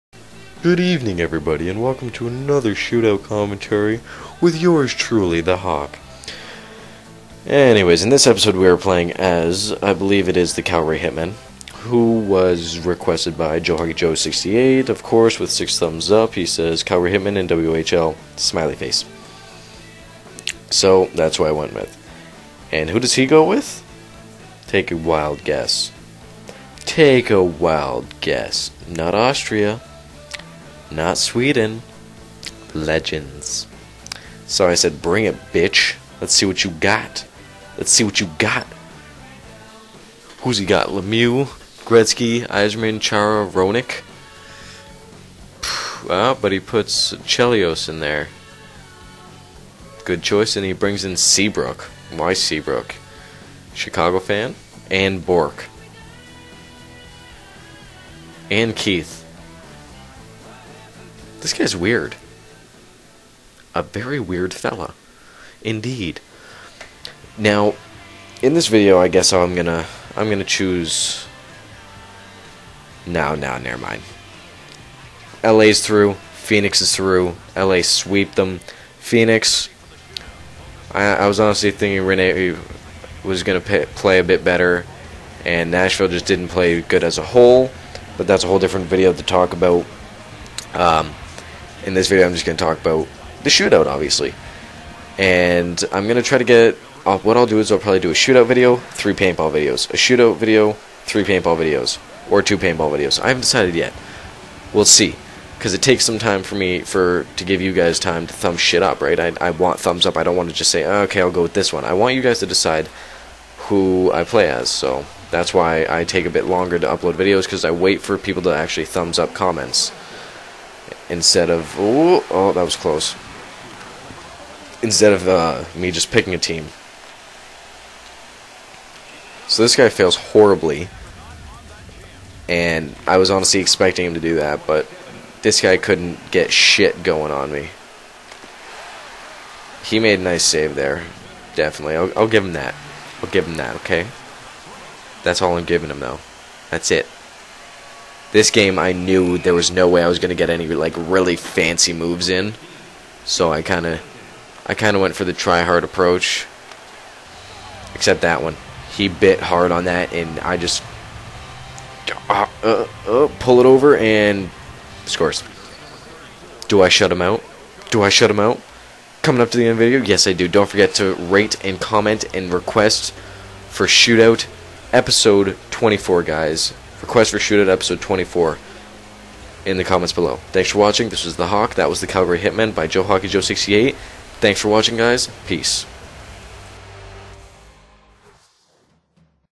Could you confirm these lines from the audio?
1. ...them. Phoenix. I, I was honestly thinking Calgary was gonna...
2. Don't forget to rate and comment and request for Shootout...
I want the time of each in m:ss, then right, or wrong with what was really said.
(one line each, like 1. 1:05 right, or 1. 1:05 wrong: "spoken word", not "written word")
1. 1:18 wrong: "Rinne", not "Calgary"
2. 2:50 right.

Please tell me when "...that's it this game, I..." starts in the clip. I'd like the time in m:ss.
2:26.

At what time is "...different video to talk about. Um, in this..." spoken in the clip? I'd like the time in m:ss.
1:28.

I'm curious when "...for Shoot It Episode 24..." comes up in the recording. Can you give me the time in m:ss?
2:57.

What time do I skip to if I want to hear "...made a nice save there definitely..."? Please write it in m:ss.
2:19.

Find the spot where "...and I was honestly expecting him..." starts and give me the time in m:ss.
2:12.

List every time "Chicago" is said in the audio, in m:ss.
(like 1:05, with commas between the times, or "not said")
0:53.